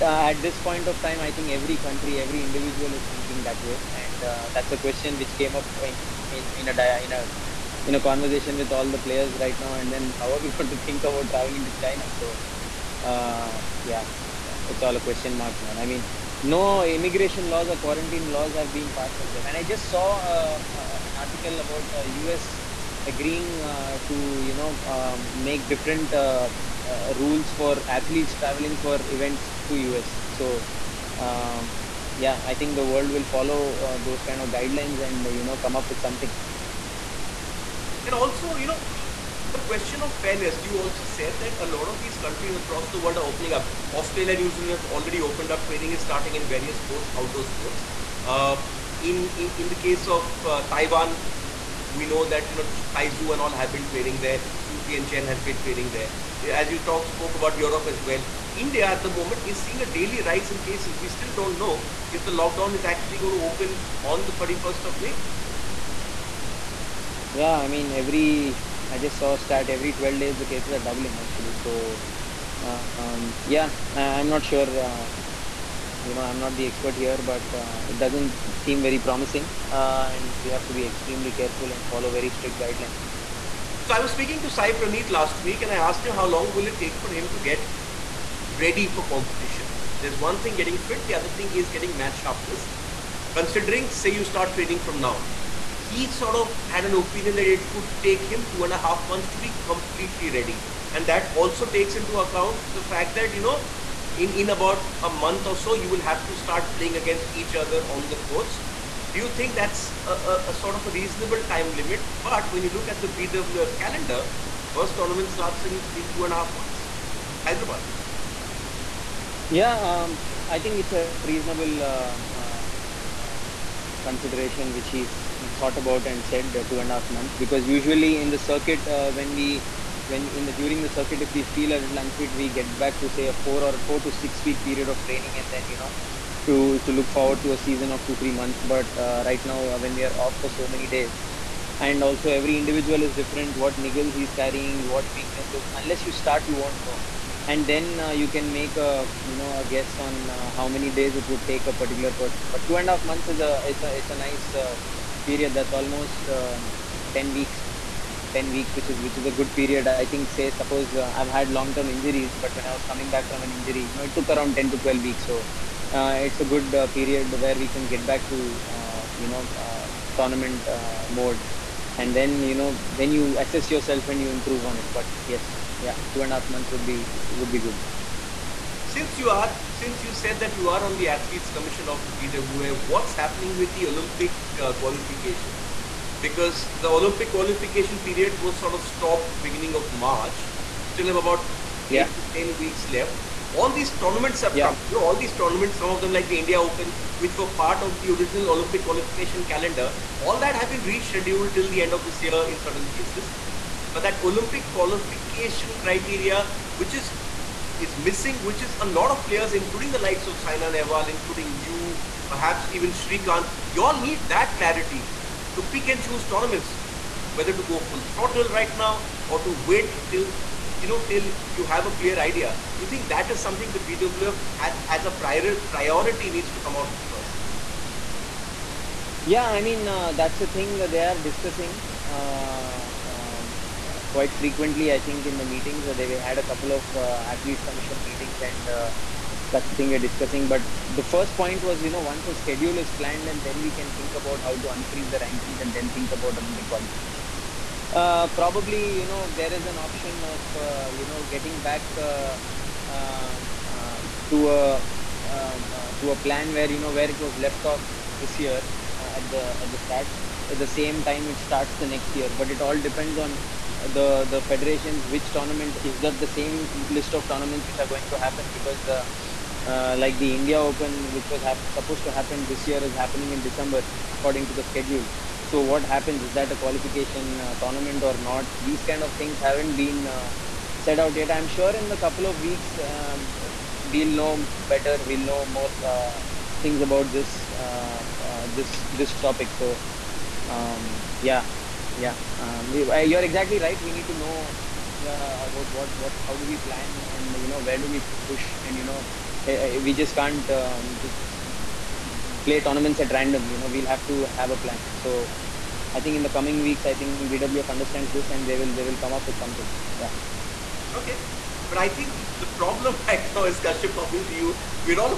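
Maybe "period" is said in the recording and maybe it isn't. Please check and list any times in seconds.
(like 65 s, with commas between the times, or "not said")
134 s, 155 s, 159 s, 166 s, 188 s.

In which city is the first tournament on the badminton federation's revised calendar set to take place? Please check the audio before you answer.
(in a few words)
Hyderabad.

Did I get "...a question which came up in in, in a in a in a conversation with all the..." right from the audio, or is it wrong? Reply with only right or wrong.
right.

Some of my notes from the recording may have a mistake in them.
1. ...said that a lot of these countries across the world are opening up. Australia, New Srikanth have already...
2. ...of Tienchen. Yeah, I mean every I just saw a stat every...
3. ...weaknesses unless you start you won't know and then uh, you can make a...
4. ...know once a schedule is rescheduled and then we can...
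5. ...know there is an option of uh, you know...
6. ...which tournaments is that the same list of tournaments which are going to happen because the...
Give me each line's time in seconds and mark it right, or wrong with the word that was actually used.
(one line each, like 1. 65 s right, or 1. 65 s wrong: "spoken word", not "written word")
1. 41 s wrong: "Zealand", not "Srikanth"
2. 64 s wrong: "May", not "Tienchen"
3. 145 s right
4. 241 s wrong: "planned", not "rescheduled"
5. 249 s right
6. 265 s right.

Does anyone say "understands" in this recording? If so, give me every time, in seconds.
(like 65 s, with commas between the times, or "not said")
307 s.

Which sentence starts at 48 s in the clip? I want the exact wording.
Uh, in, in the case of uh, Taiwan, we know that you know Tai Tzu and all have been training there.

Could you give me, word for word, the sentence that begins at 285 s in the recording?
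We'll know more uh, things about this uh, this this topic.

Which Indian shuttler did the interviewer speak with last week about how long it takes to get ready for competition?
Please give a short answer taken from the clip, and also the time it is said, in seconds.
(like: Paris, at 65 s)
Sai Praneeth, at 84 s.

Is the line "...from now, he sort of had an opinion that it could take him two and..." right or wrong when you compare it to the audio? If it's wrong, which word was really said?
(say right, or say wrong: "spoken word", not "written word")
right.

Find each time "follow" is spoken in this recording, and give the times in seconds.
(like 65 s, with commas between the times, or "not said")
33 s, 81 s.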